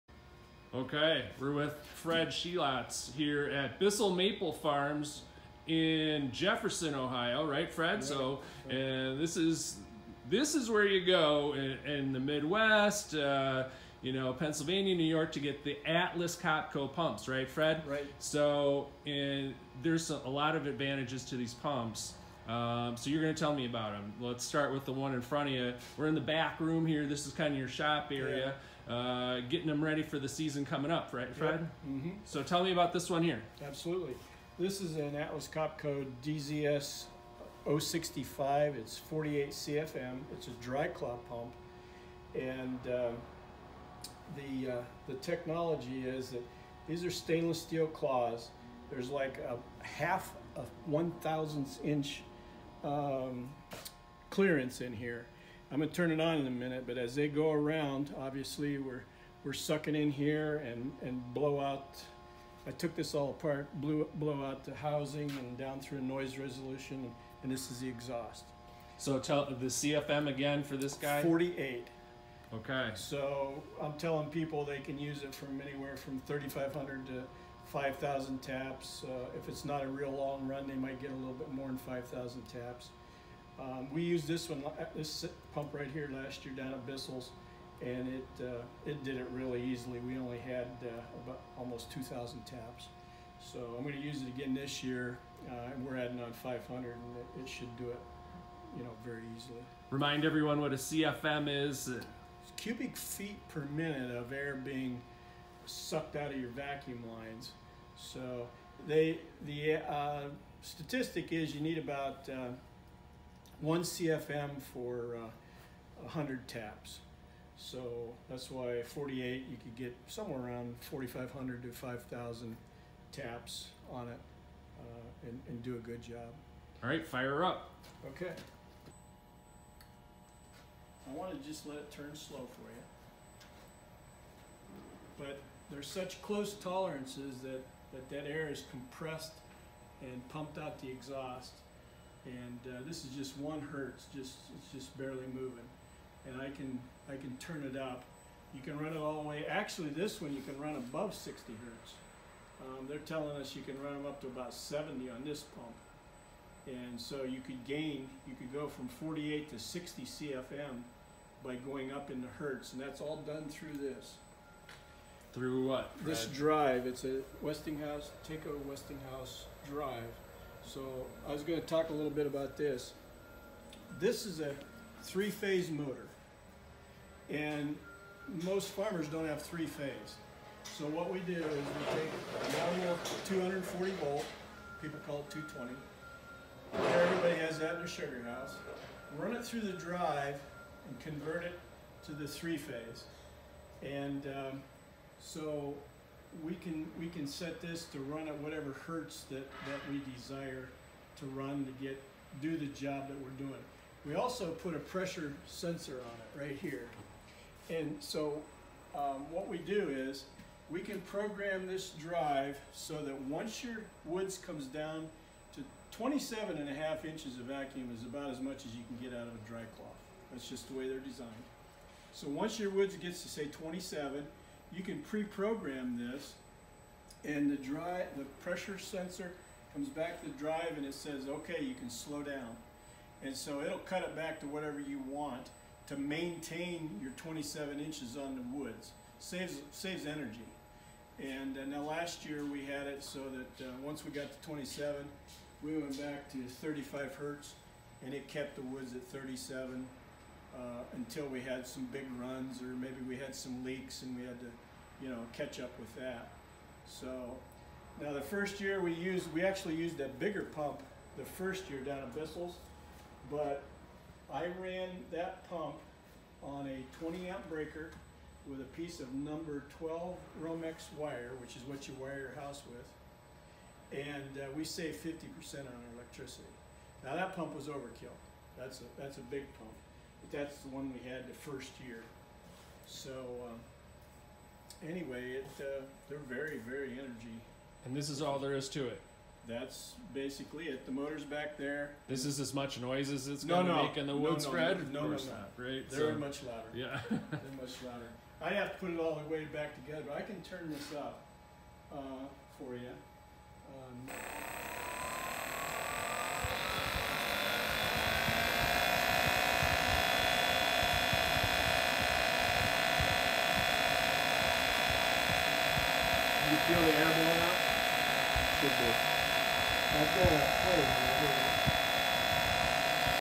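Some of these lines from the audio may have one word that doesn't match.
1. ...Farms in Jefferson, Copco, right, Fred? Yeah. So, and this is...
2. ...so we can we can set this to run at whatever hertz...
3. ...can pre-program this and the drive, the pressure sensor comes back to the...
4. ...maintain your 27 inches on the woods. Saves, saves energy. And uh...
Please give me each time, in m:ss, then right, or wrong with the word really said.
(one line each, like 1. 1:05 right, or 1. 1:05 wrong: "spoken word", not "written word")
1. 0:04 wrong: "Ohio", not "Copco"
2. 3:15 right
3. 3:44 right
4. 3:55 right.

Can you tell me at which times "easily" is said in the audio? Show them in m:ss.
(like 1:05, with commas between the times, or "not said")
1:29, 1:39.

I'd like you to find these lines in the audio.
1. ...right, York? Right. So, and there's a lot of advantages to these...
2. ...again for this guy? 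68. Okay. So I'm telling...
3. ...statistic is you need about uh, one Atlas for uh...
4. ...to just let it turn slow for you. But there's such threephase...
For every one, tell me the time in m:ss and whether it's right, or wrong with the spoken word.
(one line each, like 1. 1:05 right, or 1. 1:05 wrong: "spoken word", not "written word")
1. 0:17 wrong: "Fred", not "York"
2. 1:10 wrong: "48", not "68"
3. 1:50 wrong: "CFM", not "Atlas"
4. 2:11 wrong: "close", not "threephase".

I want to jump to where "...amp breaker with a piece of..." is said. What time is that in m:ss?
4:27.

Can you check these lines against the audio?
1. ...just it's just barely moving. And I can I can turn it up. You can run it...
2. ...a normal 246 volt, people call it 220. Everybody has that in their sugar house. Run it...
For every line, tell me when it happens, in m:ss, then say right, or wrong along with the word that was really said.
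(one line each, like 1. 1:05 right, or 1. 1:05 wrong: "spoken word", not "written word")
1. 2:24 right
2. 3:02 wrong: "240", not "246".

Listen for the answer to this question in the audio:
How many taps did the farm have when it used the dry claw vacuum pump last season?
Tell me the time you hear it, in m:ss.
1:31.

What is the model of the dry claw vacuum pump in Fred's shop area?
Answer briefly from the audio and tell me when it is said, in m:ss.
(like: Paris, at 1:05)
DZS 065, at 0:36.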